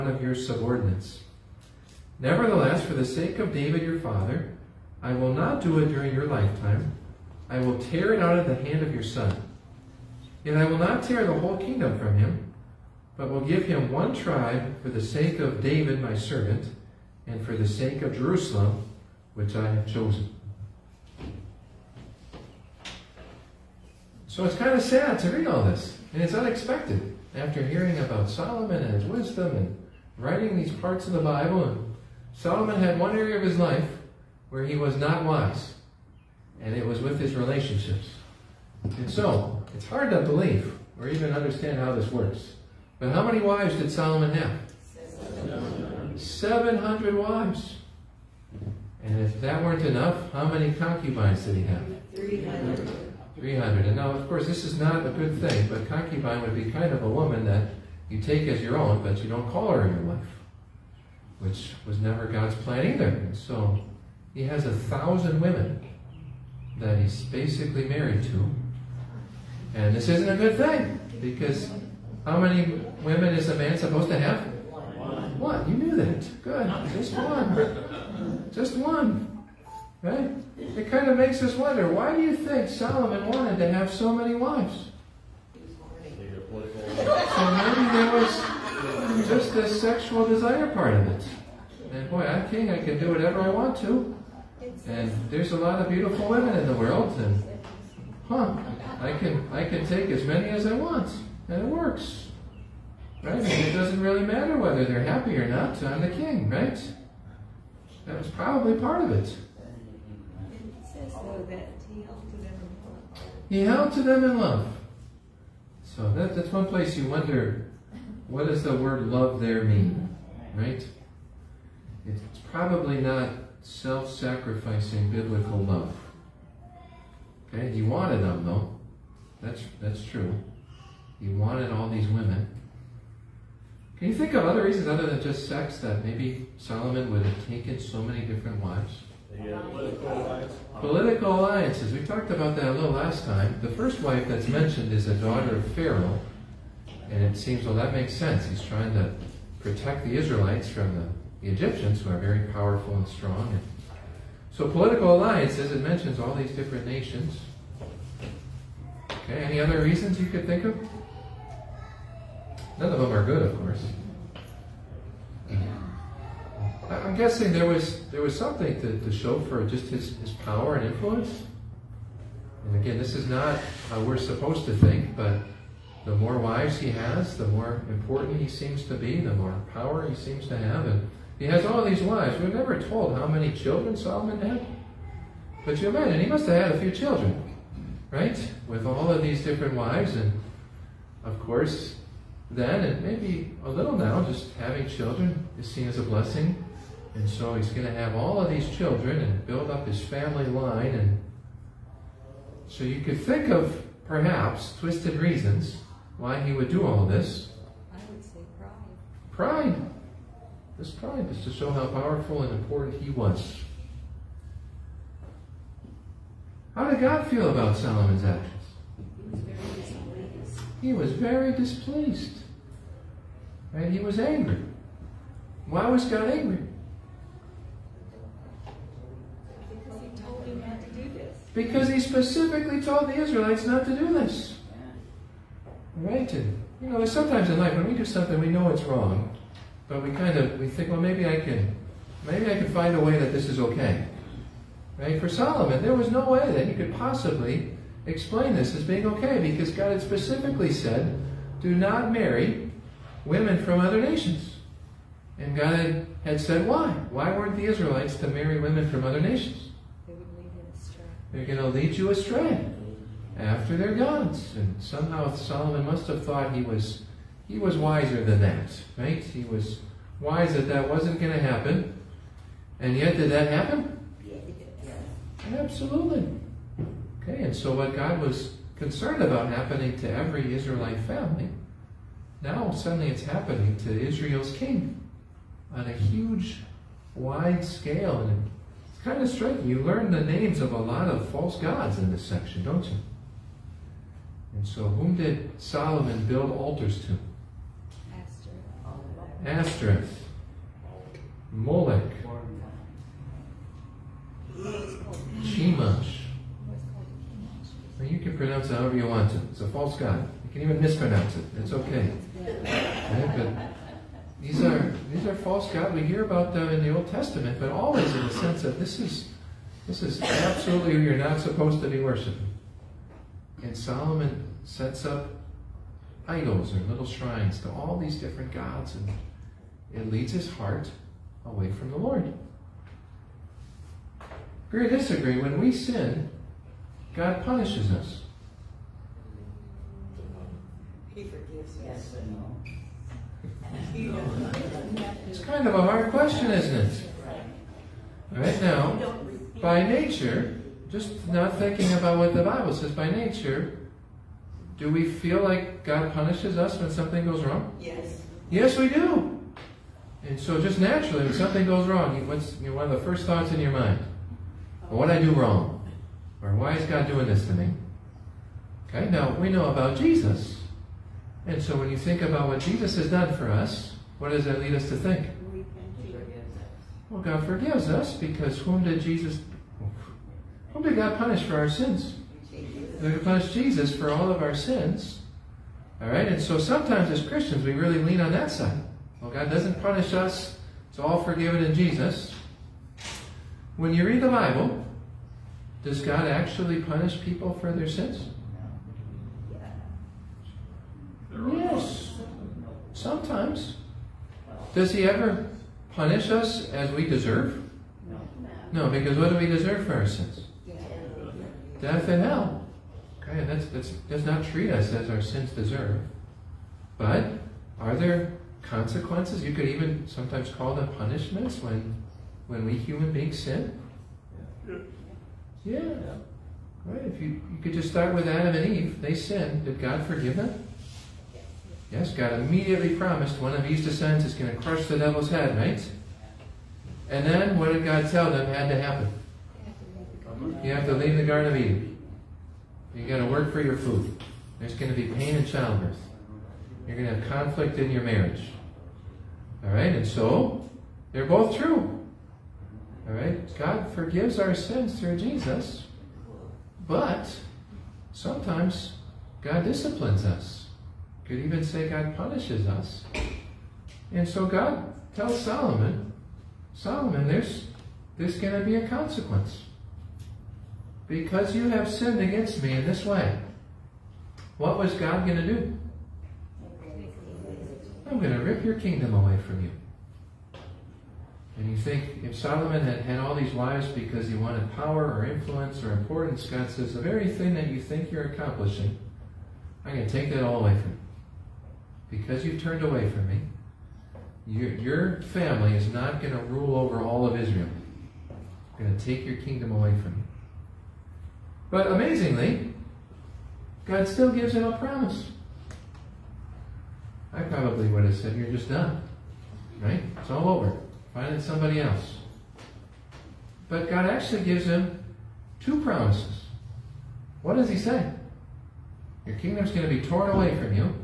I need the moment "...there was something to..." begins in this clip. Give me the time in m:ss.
2:48.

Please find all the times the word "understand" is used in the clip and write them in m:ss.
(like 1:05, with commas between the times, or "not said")
0:41.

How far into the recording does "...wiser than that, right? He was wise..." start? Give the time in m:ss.
4:27.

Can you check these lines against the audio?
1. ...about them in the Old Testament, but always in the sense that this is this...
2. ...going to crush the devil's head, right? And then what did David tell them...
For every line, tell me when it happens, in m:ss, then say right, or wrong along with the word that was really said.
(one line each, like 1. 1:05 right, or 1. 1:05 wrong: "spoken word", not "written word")
1. 5:16 right
2. 7:14 wrong: "God", not "David".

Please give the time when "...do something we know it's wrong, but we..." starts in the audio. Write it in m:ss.
3:57.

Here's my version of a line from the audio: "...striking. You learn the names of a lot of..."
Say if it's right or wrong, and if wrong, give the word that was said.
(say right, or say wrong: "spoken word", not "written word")
right.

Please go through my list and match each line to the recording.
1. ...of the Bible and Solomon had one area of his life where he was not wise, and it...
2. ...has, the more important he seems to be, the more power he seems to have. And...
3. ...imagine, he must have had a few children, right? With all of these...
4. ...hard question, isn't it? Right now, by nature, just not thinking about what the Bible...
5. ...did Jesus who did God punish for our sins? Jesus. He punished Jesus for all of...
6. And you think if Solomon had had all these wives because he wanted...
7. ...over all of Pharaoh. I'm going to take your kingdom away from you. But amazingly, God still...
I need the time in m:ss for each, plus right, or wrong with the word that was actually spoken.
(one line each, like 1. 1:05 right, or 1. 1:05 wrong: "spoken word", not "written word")
1. 0:31 right
2. 2:56 right
3. 3:05 right
4. 5:45 right
5. 6:18 right
6. 8:01 right
7. 8:16 wrong: "Israel", not "Pharaoh".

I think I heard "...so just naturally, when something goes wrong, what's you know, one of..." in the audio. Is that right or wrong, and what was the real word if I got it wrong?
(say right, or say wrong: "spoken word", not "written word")
right.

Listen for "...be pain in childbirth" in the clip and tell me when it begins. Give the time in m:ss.
7:25.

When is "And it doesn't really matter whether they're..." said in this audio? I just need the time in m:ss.
1:43.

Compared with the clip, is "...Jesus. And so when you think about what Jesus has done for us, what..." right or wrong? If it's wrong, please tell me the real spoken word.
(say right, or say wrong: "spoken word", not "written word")
right.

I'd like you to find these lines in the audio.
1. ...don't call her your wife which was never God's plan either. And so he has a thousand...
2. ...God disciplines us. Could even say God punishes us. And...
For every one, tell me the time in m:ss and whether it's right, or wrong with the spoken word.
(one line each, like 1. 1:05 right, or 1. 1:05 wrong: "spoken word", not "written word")
1. 0:59 right
2. 7:39 right.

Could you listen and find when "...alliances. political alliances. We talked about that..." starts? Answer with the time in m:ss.
2:20.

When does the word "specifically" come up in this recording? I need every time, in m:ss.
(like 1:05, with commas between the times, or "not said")
3:52, 4:10.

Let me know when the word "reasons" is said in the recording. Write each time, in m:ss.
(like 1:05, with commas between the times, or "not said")
2:14, 2:39, 3:25.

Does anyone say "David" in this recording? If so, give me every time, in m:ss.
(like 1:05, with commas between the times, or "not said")
0:03, 0:15.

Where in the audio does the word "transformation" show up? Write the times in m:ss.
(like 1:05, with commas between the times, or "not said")
not said.